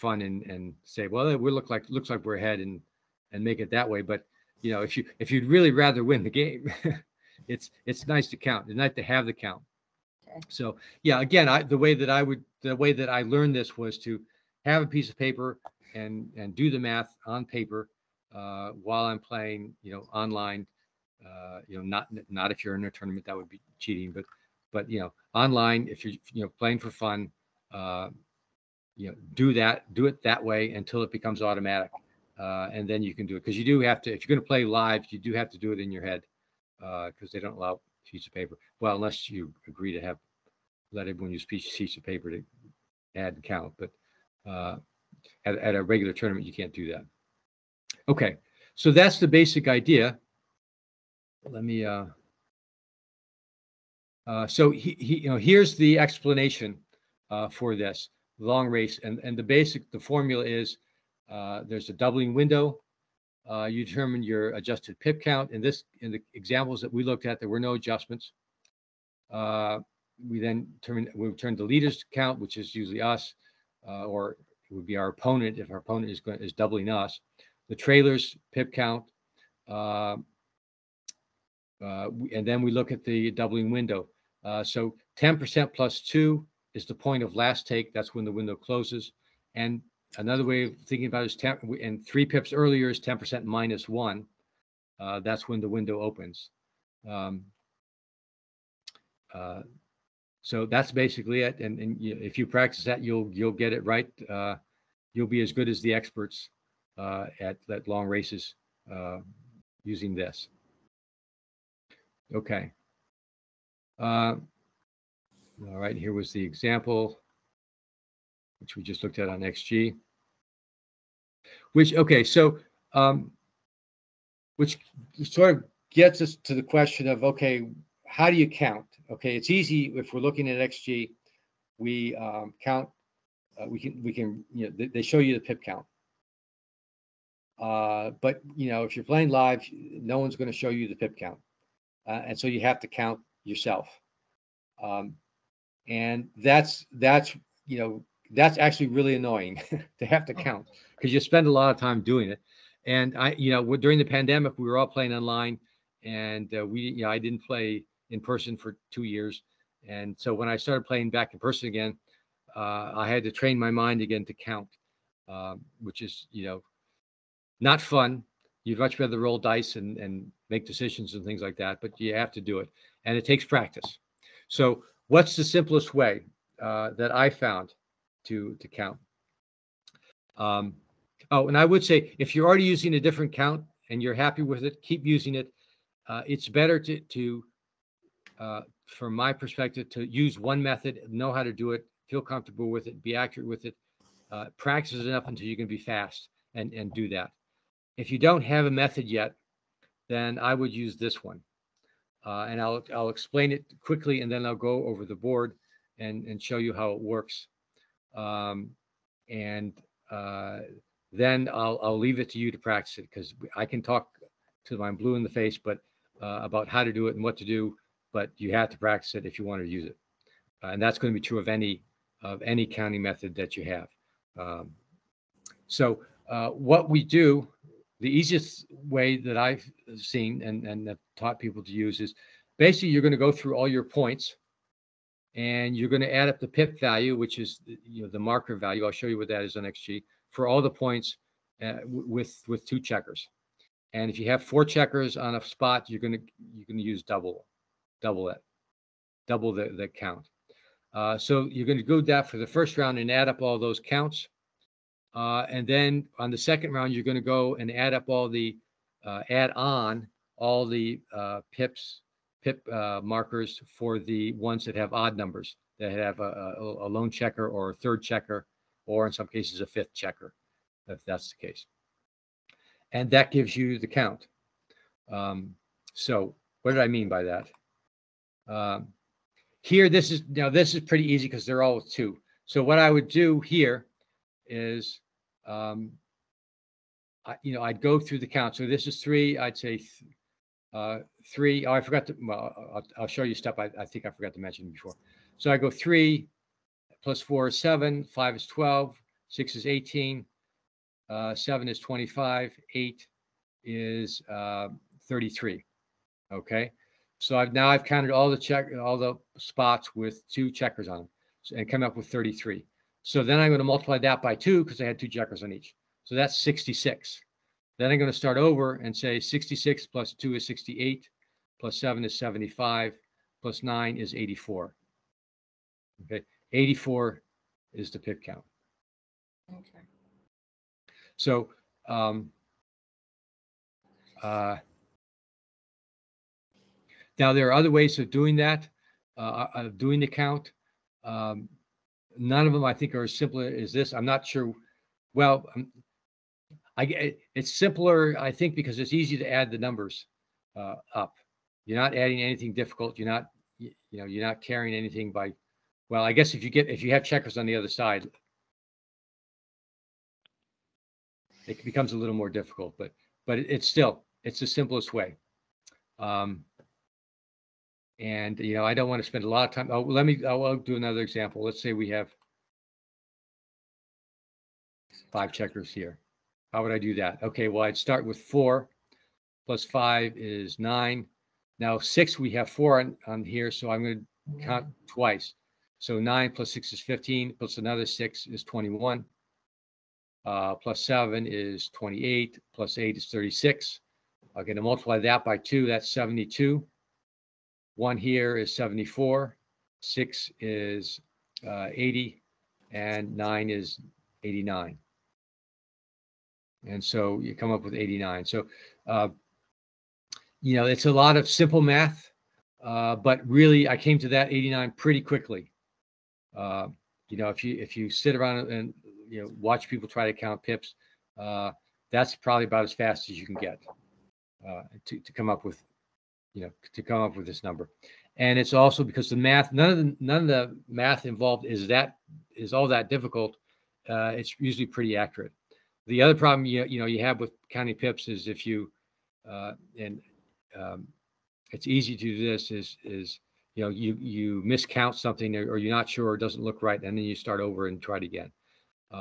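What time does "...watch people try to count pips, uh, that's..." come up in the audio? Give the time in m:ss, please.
6:59.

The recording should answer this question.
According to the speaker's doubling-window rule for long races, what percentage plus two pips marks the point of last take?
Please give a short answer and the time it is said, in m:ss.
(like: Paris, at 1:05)
10% plus two, at 1:25.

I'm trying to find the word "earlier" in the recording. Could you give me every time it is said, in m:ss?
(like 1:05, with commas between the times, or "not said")
1:32.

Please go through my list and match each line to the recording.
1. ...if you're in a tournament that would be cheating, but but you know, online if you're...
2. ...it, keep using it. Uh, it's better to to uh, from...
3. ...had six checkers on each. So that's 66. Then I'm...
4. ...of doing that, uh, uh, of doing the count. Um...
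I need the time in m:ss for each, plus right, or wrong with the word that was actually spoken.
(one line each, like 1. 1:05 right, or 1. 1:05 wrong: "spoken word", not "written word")
1. 0:22 right
2. 3:04 right
3. 5:14 wrong: "two", not "six"
4. 5:37 right.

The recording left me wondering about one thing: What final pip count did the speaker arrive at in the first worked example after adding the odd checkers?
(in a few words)
84.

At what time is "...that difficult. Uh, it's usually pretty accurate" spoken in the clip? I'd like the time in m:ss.
7:12.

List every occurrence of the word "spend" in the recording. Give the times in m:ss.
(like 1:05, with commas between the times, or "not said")
2:31, 6:09.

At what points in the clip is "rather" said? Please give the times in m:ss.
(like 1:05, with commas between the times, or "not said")
0:05, 2:48.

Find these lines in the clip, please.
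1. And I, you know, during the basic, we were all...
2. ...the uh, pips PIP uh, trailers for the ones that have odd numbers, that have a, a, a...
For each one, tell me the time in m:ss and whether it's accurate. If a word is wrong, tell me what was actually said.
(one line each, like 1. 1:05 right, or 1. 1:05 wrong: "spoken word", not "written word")
1. 2:32 wrong: "pandemic", not "basic"
2. 4:20 wrong: "markers", not "trailers".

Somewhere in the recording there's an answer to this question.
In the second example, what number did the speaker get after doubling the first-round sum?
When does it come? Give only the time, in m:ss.
6:35.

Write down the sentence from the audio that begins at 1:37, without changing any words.
Um, uh, so that's basically it.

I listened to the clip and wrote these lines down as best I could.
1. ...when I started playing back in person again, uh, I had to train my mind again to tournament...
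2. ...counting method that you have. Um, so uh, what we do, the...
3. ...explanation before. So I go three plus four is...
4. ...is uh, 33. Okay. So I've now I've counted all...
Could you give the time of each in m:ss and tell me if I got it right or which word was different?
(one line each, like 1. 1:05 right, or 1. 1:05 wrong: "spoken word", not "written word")
1. 2:40 wrong: "count", not "tournament"
2. 3:42 right
3. 4:54 wrong: "mention", not "explanation"
4. 5:03 right.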